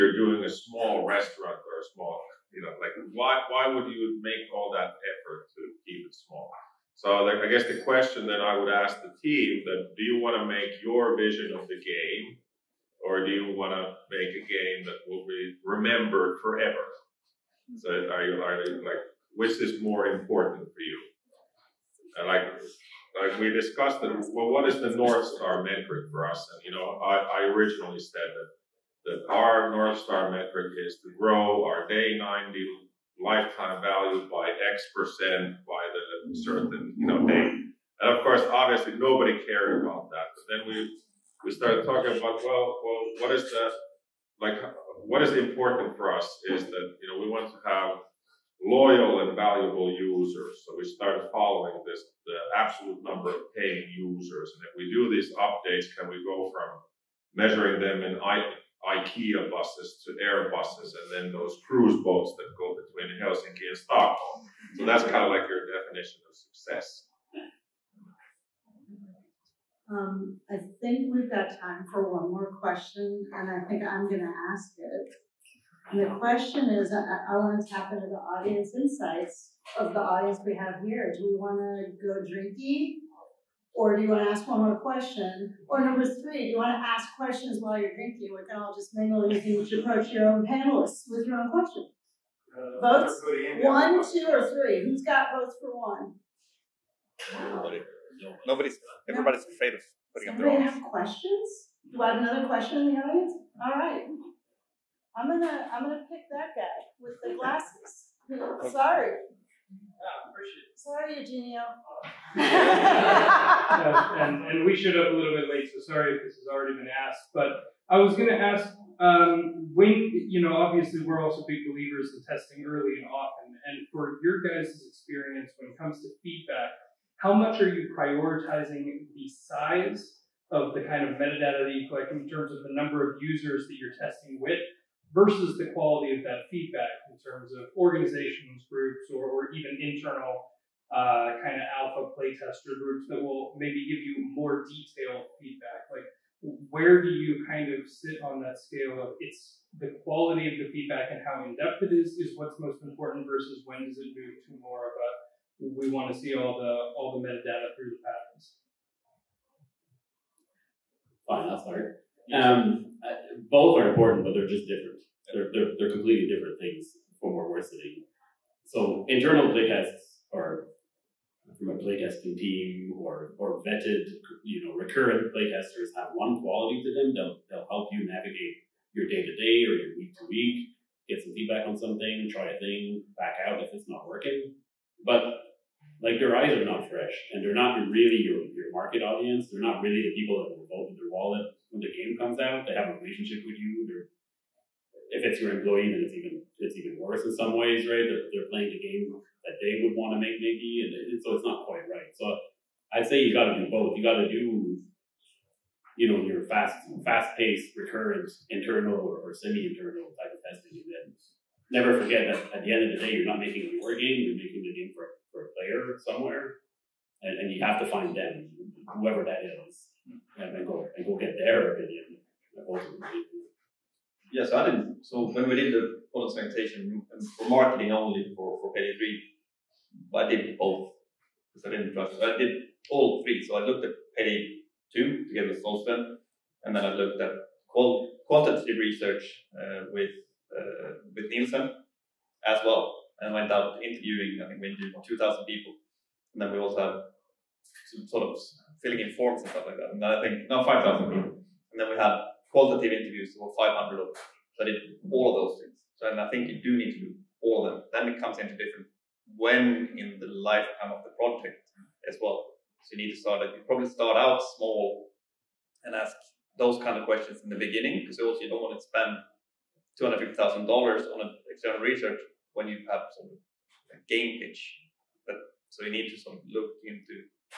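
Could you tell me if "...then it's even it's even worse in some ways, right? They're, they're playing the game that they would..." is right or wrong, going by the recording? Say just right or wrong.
right.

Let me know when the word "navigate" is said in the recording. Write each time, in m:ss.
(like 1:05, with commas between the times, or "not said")
2:58.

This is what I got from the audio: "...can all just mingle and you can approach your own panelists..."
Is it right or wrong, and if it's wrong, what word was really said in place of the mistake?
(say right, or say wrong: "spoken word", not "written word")
right.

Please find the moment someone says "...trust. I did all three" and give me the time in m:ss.
3:51.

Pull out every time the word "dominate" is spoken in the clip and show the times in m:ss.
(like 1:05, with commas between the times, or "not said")
not said.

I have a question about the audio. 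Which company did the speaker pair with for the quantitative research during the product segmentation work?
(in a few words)
Nielsen.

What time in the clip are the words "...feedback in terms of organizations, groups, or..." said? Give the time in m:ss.
2:16.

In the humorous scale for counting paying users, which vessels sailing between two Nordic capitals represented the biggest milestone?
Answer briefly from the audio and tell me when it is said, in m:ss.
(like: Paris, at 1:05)
Cruise boats, at 1:01.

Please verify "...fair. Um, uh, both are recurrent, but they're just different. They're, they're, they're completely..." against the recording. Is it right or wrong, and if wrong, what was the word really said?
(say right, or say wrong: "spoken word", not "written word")
wrong: "important", not "recurrent".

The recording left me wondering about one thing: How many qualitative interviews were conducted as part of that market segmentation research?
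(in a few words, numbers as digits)
500.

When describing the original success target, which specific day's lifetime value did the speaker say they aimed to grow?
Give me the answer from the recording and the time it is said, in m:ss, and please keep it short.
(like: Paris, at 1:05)
Day 90, at 0:31.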